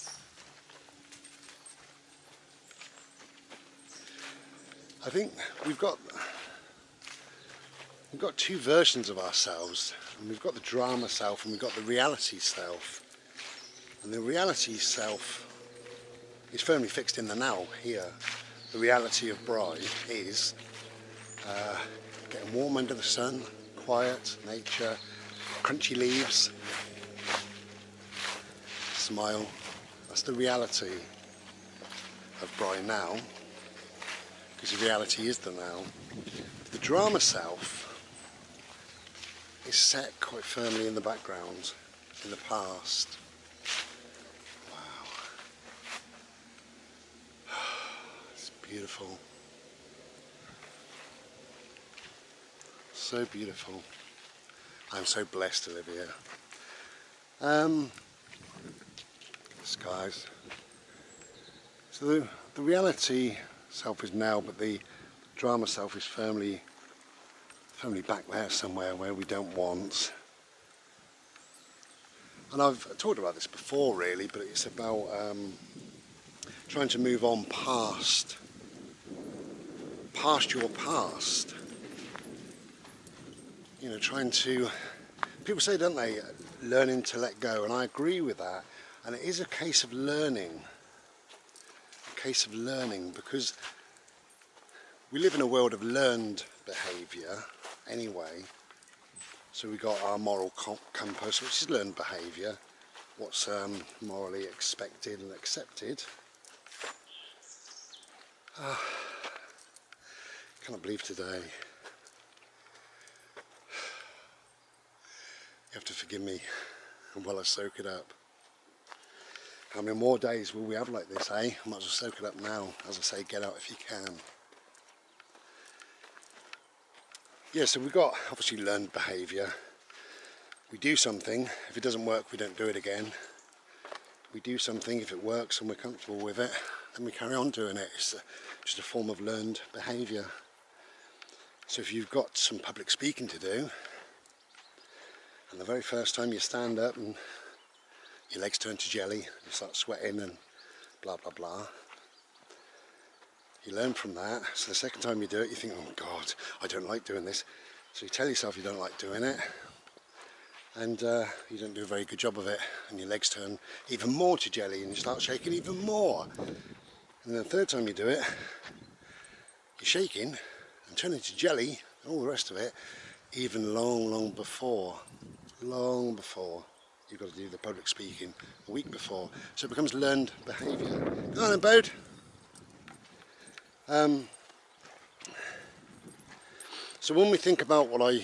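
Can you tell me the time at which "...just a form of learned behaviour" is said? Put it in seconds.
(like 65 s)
138 s.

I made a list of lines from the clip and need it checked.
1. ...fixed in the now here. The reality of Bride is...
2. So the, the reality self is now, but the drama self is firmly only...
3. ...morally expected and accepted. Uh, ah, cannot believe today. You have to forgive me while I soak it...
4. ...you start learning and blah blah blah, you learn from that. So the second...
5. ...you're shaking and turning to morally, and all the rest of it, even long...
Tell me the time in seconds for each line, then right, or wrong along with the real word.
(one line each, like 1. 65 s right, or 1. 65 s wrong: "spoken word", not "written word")
1. 16 s right
2. 61 s right
3. 104 s right
4. 149 s wrong: "sweating", not "learning"
5. 169 s wrong: "jelly", not "morally".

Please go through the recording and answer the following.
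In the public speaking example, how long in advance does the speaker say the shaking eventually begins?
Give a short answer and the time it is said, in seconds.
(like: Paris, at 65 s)
a week before, at 178 s.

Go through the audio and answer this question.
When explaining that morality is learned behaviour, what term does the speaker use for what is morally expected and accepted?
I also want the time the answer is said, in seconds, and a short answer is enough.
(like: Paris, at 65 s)
moral compass, at 100 s.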